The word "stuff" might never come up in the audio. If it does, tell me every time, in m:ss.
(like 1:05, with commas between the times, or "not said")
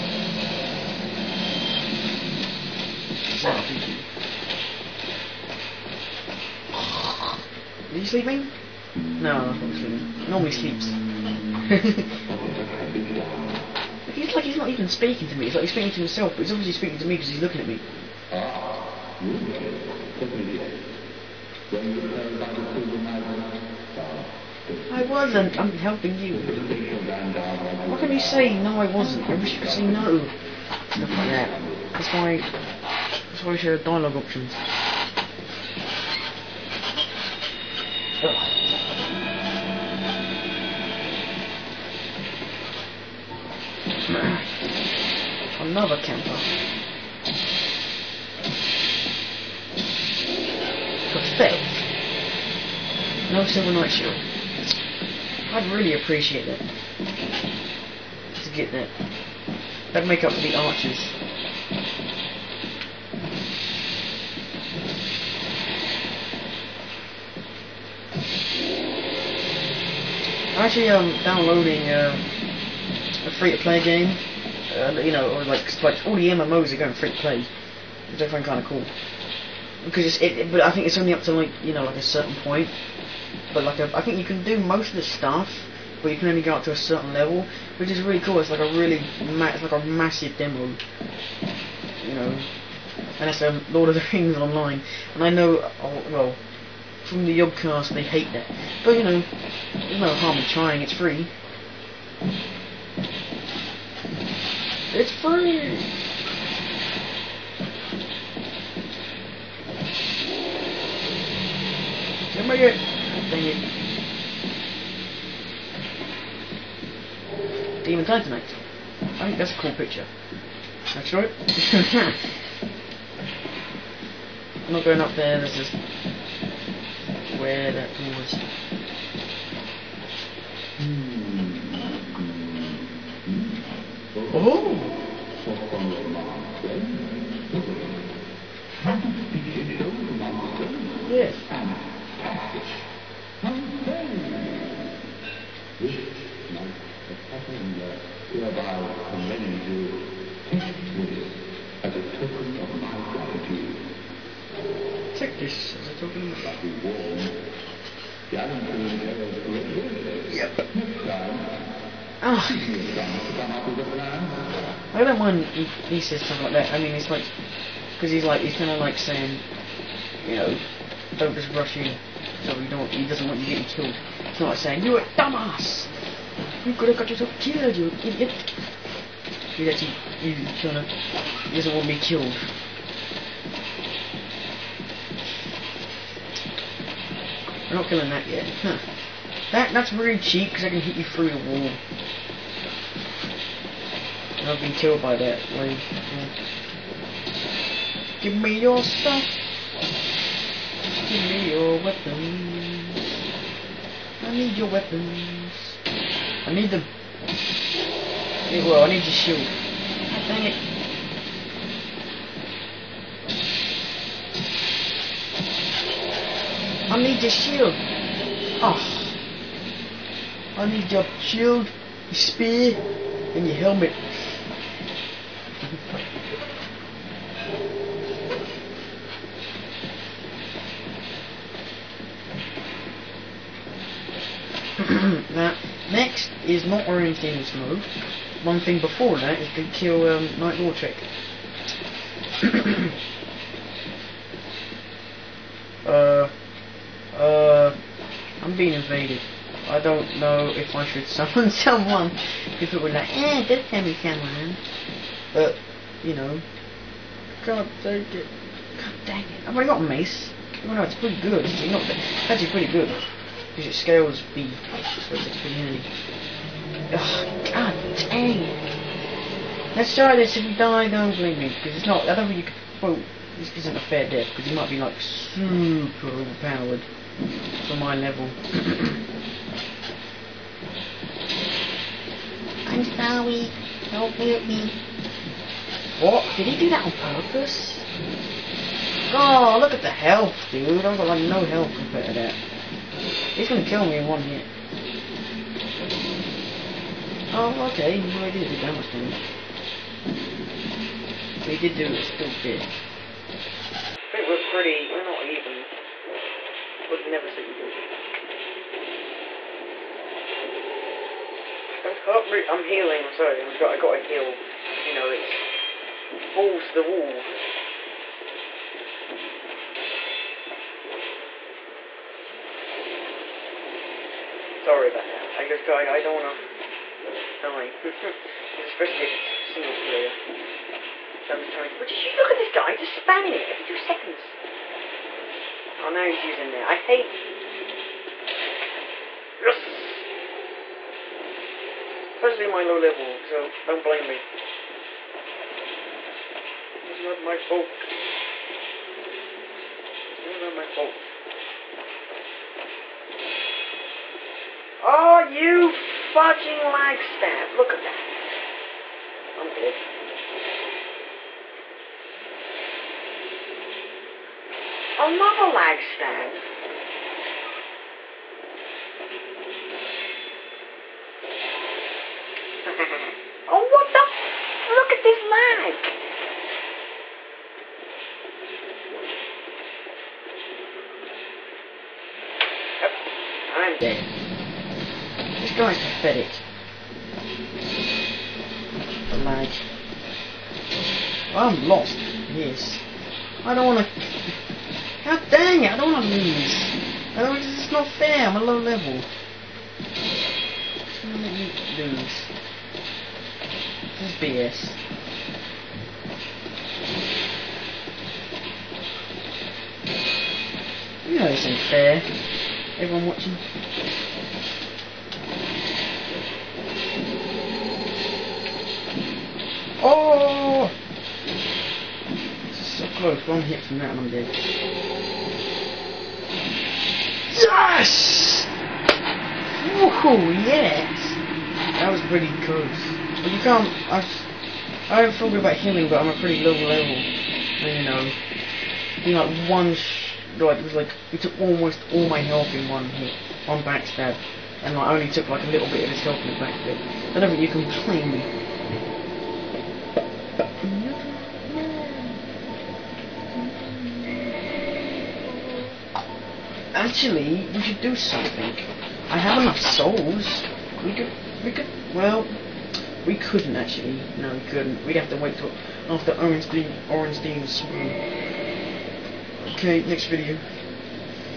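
0:30, 1:25, 3:18.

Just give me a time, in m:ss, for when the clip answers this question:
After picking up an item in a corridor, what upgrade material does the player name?
1:57.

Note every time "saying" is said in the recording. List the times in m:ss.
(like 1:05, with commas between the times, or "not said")
2:48, 2:54.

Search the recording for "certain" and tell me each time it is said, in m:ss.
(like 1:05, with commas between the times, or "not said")
1:22, 1:26.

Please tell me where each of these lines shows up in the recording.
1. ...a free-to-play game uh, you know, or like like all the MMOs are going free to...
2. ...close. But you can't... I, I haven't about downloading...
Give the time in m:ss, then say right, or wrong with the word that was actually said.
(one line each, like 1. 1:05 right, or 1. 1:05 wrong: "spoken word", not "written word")
1. 1:13 right
2. 7:12 wrong: "healing", not "downloading".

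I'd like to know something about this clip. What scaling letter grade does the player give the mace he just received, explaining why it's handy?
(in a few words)
B.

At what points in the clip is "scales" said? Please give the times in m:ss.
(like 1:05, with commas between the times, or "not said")
4:23.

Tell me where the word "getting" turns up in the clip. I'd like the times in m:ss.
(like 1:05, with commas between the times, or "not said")
2:53.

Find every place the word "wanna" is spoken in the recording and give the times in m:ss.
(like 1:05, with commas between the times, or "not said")
5:26.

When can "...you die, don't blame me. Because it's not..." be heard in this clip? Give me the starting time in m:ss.
4:30.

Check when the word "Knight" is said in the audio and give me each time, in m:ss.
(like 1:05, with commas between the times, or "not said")
0:53, 4:00.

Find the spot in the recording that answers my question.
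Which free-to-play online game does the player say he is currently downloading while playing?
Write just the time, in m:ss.
1:33.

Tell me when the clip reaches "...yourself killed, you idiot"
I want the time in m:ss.
2:57.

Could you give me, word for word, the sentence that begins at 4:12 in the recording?
If it were like, eh, send me someone.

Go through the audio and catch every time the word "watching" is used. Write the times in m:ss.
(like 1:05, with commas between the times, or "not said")
5:56, 6:53.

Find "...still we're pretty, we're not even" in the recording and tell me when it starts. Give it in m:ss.
5:02.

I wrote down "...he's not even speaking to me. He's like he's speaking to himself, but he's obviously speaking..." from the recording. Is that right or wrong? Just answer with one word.
right.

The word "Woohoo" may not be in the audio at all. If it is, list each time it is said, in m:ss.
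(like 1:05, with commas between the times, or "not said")
7:09.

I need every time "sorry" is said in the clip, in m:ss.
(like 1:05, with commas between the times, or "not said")
4:42, 5:13, 5:24.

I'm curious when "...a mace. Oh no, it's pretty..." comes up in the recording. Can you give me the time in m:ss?
4:19.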